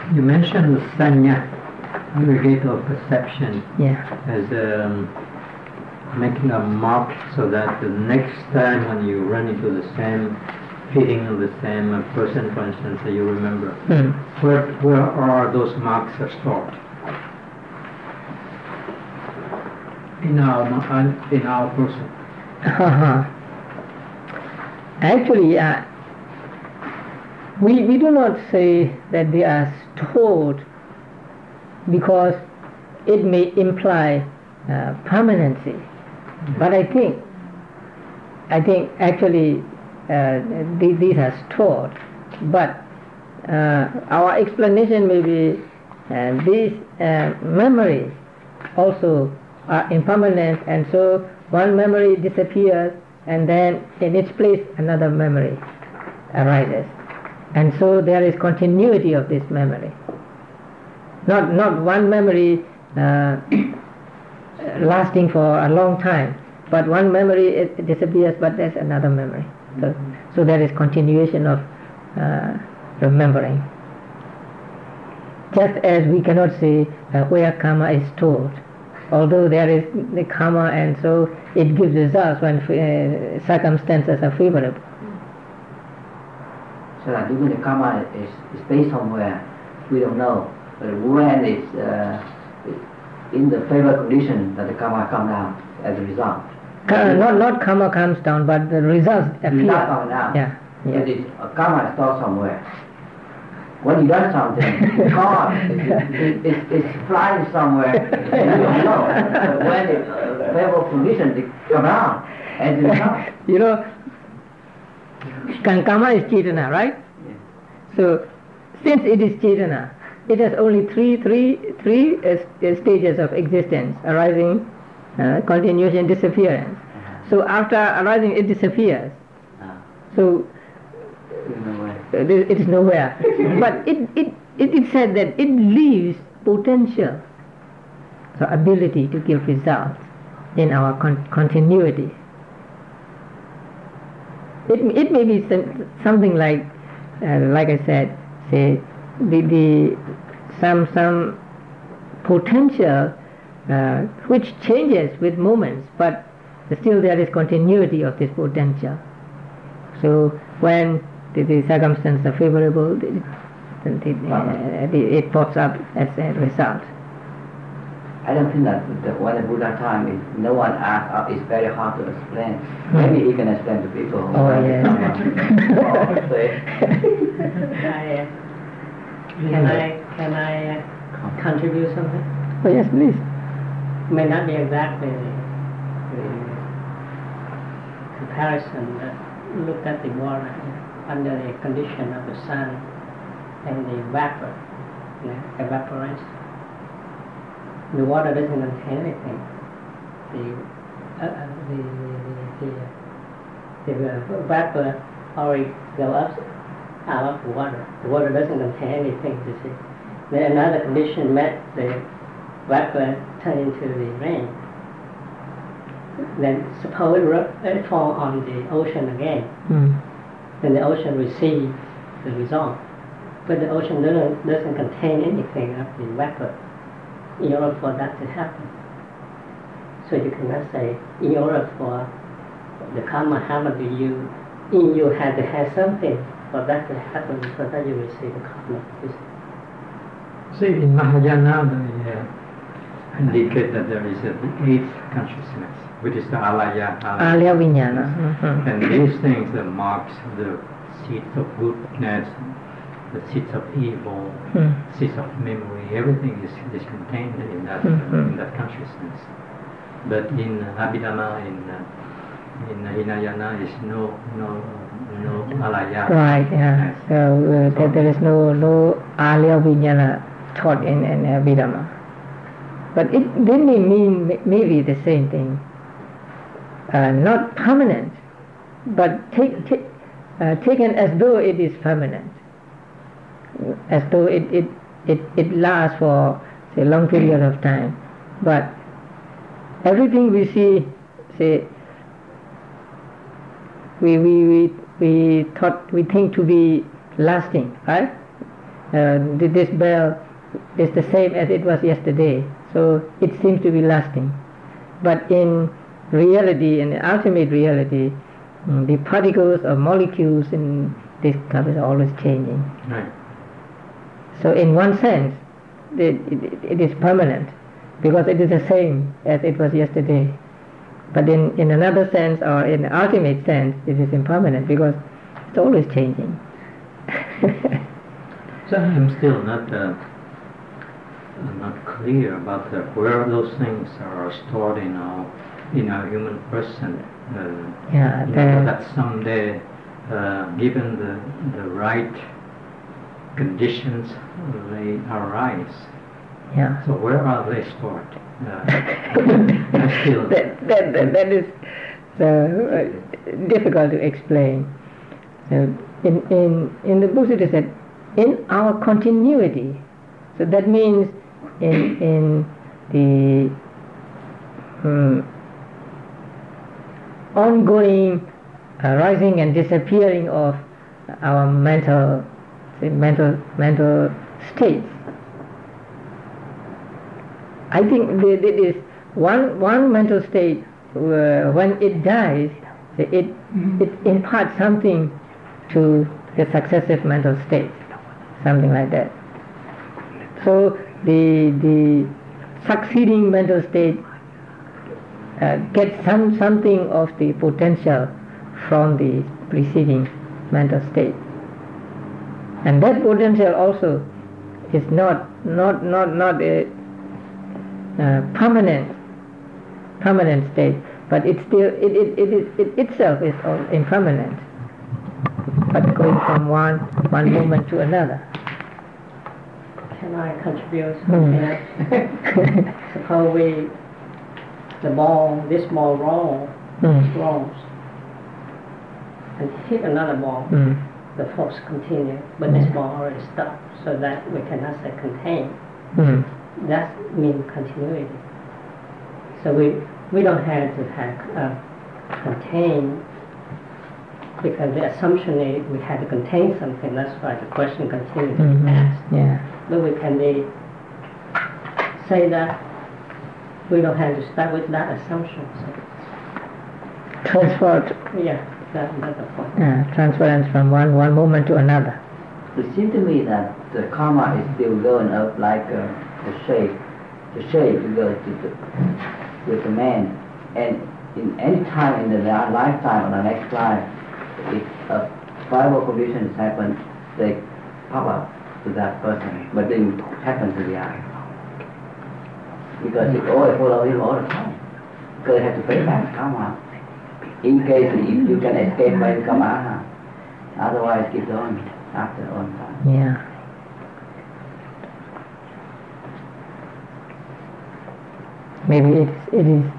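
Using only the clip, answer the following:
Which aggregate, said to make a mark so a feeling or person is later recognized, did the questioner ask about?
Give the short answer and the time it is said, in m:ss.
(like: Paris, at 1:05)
sanya, at 0:01.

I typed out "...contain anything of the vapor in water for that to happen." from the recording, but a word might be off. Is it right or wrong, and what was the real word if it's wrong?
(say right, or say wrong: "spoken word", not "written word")
wrong: "order", not "water".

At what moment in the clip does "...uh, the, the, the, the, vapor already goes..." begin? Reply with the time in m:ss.
3:21.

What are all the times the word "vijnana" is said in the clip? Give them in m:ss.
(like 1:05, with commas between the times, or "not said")
4:07, 4:29.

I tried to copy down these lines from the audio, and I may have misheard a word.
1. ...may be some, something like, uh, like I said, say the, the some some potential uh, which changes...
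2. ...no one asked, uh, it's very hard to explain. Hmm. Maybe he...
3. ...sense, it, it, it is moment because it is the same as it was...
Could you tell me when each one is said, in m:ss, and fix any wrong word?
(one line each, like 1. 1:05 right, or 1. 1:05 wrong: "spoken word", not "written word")
1. 2:25 right
2. 2:50 right
3. 5:14 wrong: "permanent", not "moment".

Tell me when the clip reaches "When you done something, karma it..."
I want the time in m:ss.
1:43.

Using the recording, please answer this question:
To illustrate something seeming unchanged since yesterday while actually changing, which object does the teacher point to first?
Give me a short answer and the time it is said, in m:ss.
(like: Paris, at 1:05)
this bell, at 4:59.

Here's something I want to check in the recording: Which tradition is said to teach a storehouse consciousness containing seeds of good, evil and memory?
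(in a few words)
Mahayana.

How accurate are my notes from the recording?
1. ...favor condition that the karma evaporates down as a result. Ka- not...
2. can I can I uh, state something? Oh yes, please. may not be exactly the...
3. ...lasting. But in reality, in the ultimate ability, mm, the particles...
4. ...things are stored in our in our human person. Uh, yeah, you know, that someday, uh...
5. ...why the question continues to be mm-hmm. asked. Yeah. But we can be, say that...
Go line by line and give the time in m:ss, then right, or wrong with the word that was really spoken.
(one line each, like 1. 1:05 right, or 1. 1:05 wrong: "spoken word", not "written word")
1. 1:33 wrong: "comes", not "evaporates"
2. 2:59 wrong: "contribute", not "state"
3. 5:03 wrong: "reality", not "ability"
4. 5:33 right
5. 7:27 right.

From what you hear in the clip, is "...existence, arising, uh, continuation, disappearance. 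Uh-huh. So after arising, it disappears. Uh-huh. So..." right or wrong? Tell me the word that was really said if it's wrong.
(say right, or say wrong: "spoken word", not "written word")
right.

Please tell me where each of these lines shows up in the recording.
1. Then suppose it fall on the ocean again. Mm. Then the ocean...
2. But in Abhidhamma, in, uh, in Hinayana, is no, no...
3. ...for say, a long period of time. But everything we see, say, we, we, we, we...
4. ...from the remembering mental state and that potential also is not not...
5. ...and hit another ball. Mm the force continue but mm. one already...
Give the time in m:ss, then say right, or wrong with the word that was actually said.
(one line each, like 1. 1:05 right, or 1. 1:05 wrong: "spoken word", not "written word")
1. 3:36 right
2. 4:20 right
3. 4:45 right
4. 6:38 wrong: "preceding", not "remembering"
5. 7:09 right.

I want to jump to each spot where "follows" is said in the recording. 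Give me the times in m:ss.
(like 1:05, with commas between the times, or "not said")
8:03.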